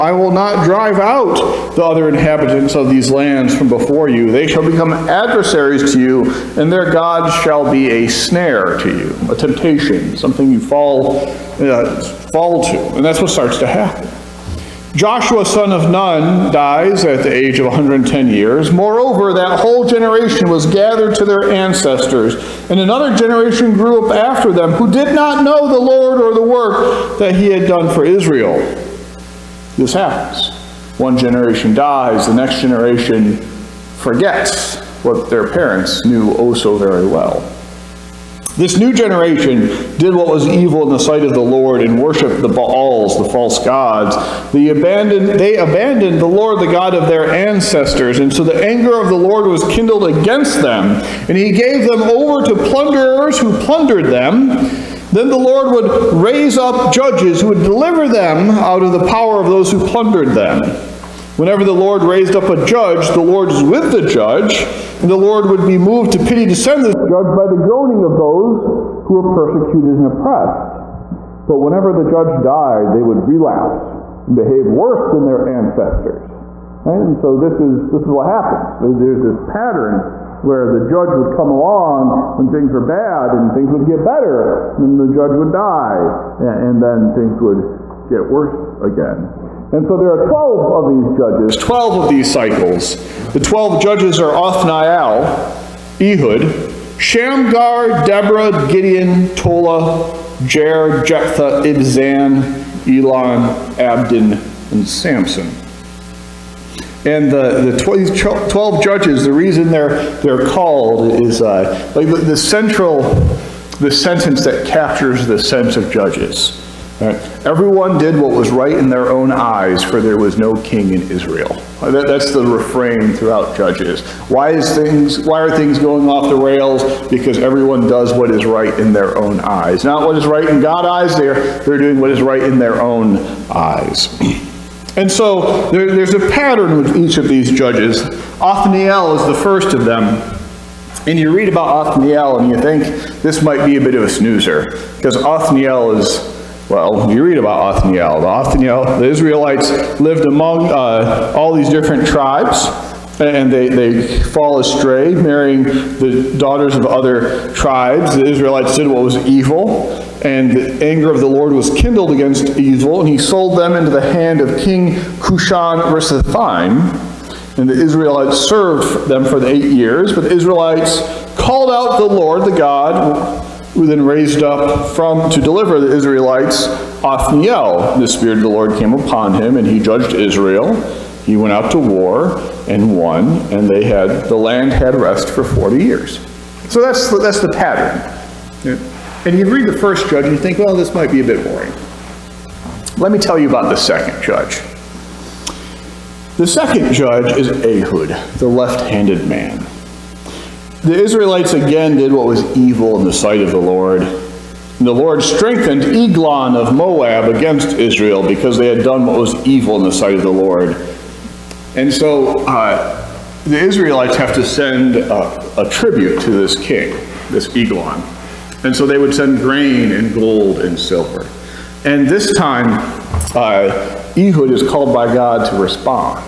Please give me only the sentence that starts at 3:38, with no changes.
And so they would send grain and gold and silver.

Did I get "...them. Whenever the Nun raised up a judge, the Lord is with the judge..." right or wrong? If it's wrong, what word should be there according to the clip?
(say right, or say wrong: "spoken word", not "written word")
wrong: "Lord", not "Nun".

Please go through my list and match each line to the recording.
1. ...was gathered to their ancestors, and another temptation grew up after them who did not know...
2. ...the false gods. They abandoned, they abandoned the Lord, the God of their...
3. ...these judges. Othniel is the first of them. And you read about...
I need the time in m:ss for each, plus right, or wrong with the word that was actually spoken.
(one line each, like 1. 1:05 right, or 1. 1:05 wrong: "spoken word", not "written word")
1. 0:20 wrong: "generation", not "temptation"
2. 0:43 right
3. 2:17 right.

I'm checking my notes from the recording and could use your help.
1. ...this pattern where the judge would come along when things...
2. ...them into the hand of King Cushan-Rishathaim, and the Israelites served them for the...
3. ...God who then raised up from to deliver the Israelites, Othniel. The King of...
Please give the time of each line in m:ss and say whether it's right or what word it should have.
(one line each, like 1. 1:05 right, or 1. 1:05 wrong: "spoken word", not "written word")
1. 1:19 right
2. 2:43 right
3. 2:52 wrong: "Spirit", not "King".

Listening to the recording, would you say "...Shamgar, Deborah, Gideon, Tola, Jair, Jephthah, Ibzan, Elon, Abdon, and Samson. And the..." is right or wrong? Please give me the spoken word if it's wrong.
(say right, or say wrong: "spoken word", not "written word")
right.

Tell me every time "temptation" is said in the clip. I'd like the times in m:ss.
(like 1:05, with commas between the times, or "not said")
0:09.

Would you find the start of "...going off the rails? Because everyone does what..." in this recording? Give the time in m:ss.
2:05.